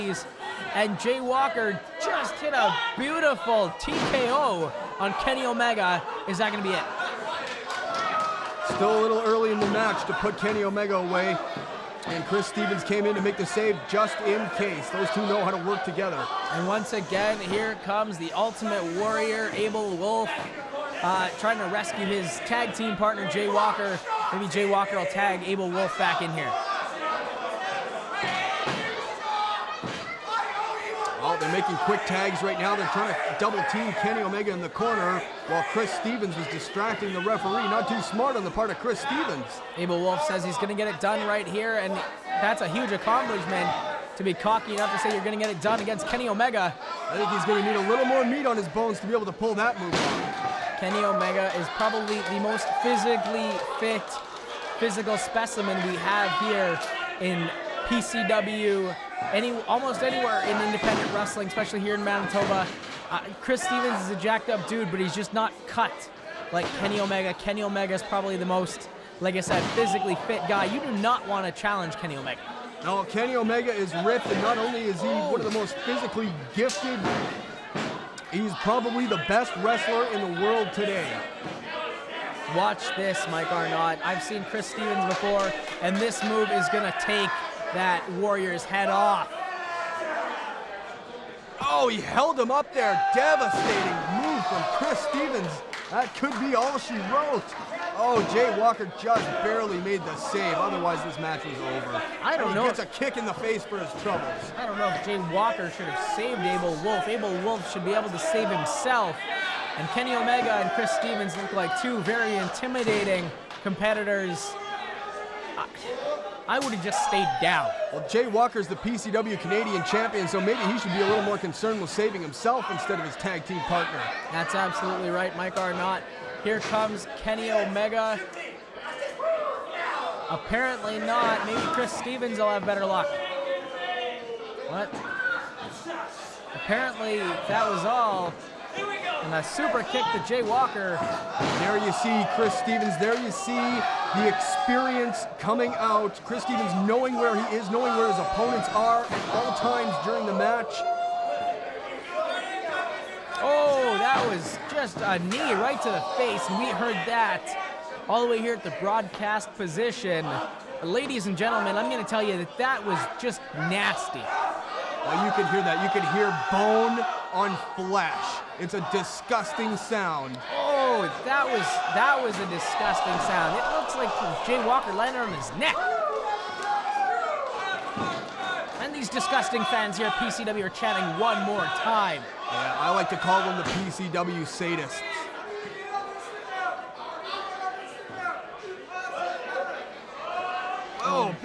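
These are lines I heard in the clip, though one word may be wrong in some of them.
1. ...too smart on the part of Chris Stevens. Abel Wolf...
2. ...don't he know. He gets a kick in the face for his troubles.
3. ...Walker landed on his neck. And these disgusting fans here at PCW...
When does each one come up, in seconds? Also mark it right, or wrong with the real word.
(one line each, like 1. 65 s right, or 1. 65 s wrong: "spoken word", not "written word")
1. 37 s right
2. 102 s right
3. 174 s right.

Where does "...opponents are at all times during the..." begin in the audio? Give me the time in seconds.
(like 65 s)
148 s.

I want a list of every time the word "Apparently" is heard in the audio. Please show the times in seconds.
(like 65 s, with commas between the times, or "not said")
130 s, 136 s.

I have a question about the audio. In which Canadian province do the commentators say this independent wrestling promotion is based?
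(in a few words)
Manitoba.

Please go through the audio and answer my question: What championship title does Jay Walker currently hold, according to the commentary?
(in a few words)
PCW Canadian champion.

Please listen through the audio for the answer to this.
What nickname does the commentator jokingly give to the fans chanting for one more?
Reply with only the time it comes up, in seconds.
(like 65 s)
183 s.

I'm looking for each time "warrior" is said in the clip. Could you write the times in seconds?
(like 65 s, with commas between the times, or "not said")
18 s, 88 s.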